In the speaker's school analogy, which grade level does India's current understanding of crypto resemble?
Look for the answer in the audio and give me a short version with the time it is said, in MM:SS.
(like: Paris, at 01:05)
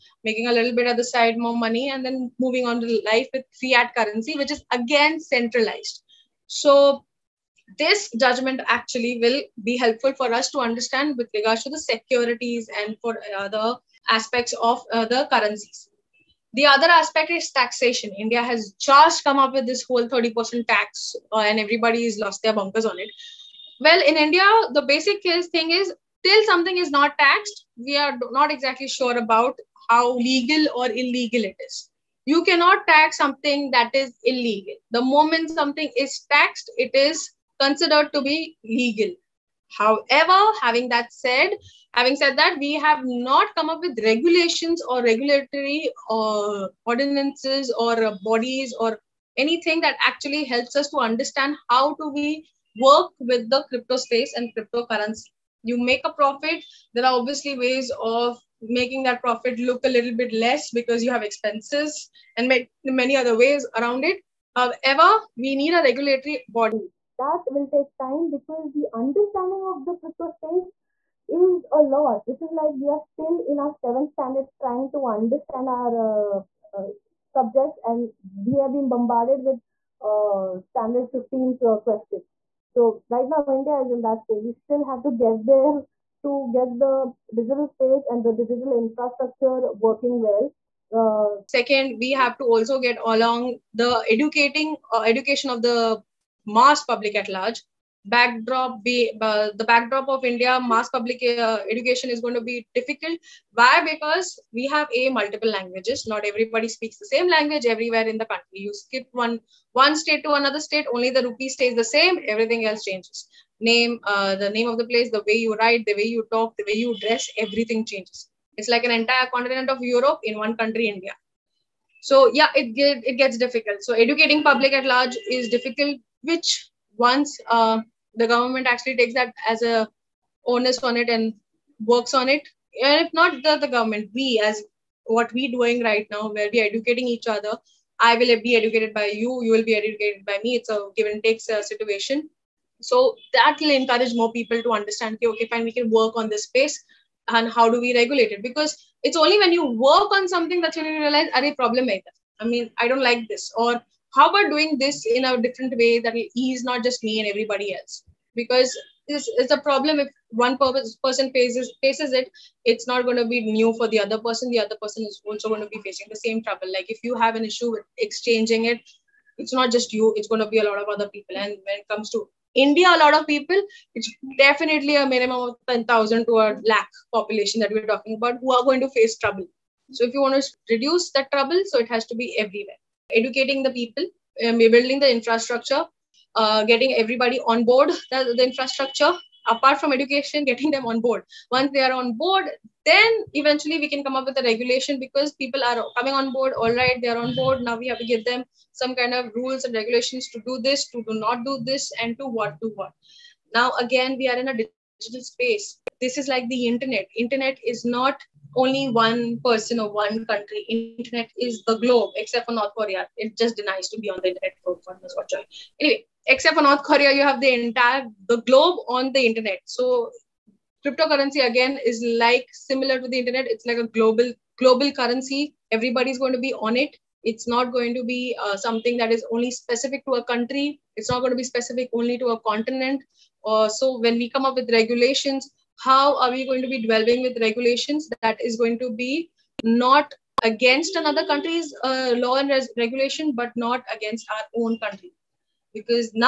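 Seventh standard, at 01:13.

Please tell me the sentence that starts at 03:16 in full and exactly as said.
All right, they are on board.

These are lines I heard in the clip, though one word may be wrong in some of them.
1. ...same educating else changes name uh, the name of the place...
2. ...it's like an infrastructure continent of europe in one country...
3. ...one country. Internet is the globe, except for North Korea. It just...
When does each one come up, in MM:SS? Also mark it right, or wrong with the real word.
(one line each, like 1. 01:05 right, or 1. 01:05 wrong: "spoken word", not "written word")
1. 01:51 wrong: "everything", not "educating"
2. 01:58 wrong: "entire", not "infrastructure"
3. 03:29 right.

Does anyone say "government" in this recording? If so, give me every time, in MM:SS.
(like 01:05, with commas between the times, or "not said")
02:08, 02:13.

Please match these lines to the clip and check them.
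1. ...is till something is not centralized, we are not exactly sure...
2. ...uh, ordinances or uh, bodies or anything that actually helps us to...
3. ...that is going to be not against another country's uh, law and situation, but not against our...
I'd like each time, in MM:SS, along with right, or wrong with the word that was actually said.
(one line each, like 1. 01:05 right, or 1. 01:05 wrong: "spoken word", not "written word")
1. 00:25 wrong: "taxed", not "centralized"
2. 00:46 right
3. 03:58 wrong: "regulation", not "situation".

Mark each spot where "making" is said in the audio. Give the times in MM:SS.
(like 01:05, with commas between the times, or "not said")
00:00, 00:58.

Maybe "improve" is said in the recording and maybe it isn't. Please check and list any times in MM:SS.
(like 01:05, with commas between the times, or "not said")
not said.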